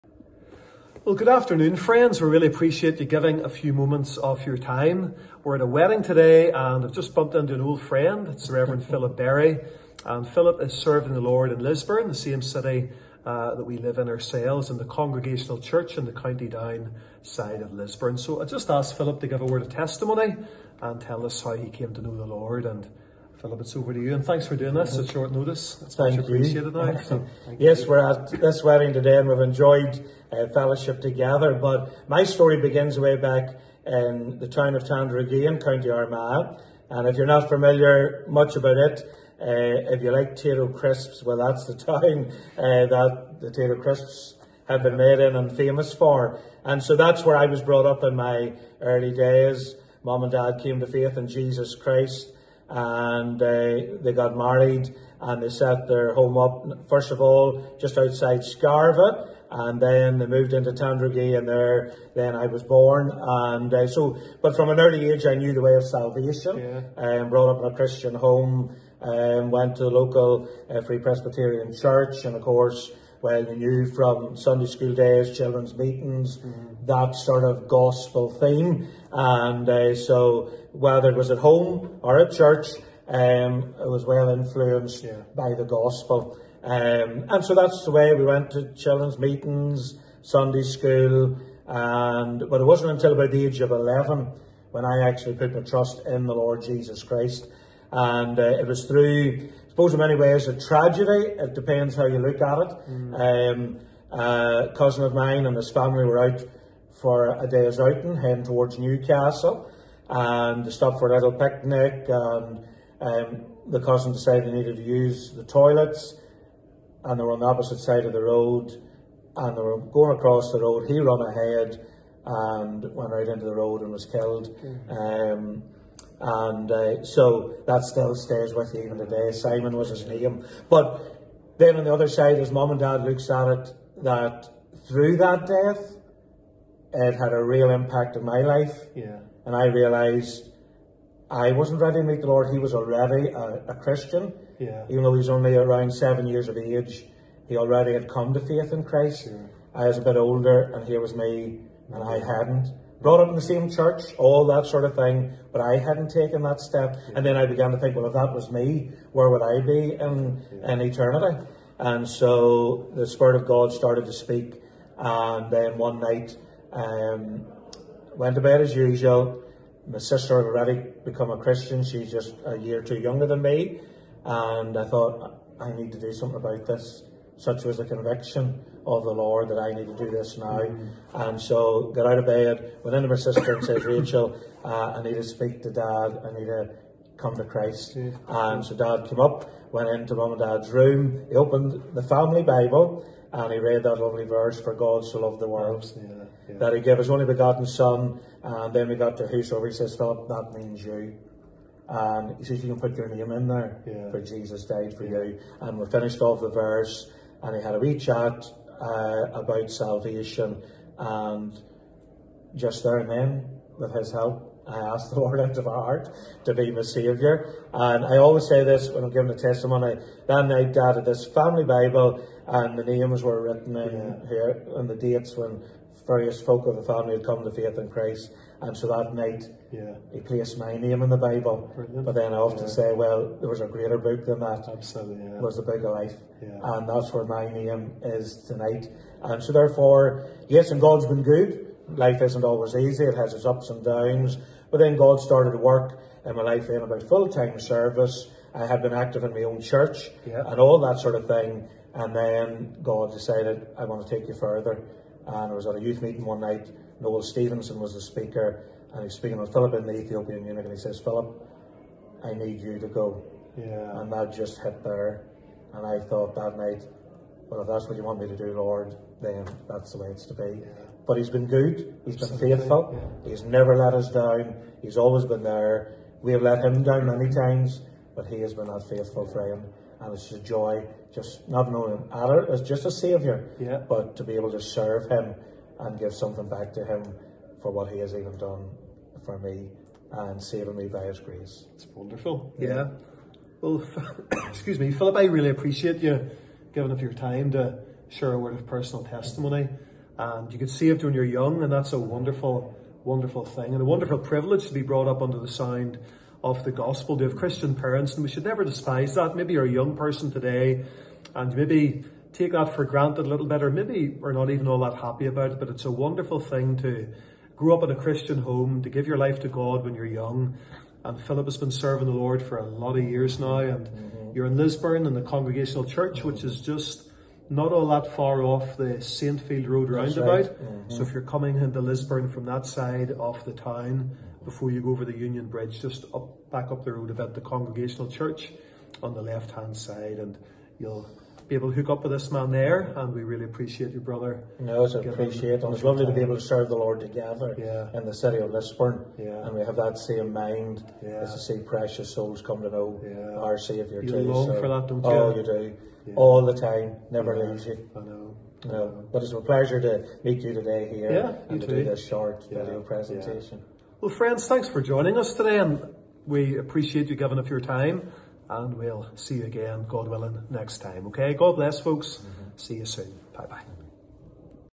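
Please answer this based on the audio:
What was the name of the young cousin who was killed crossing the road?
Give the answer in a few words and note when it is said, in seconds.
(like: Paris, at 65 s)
Simon, at 129 s.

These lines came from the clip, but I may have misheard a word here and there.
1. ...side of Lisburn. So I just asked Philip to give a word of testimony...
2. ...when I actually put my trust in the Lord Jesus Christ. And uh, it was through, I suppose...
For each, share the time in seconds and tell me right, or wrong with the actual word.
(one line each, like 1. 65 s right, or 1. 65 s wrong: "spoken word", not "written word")
1. 17 s right
2. 94 s right.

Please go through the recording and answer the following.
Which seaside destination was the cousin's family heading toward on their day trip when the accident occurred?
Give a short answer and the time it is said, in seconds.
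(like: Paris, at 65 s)
Newcastle, at 108 s.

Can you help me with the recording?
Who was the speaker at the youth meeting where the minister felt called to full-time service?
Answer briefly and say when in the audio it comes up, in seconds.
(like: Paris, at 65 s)
Noel Stevenson, at 256 s.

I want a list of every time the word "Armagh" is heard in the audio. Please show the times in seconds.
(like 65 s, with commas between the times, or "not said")
35 s.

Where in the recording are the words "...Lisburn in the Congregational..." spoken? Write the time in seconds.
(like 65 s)
324 s.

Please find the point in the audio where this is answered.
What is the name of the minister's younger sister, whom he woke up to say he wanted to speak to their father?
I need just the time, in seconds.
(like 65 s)
183 s.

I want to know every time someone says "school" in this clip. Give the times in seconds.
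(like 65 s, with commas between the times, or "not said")
74 s, 90 s.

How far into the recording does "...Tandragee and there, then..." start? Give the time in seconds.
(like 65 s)
60 s.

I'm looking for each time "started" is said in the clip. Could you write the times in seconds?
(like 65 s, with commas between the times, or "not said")
163 s, 245 s.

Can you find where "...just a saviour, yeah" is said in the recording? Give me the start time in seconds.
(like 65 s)
282 s.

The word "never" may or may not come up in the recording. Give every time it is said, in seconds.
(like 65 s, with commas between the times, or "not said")
273 s, 308 s, 357 s.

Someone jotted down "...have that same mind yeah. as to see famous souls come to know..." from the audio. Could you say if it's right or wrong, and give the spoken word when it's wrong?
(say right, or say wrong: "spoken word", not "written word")
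wrong: "precious", not "famous".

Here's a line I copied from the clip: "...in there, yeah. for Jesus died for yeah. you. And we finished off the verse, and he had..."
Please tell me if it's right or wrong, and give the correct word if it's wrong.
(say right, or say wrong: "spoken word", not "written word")
right.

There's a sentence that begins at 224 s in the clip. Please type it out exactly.
here and the dates when various folk of the family had come to faith in Christ.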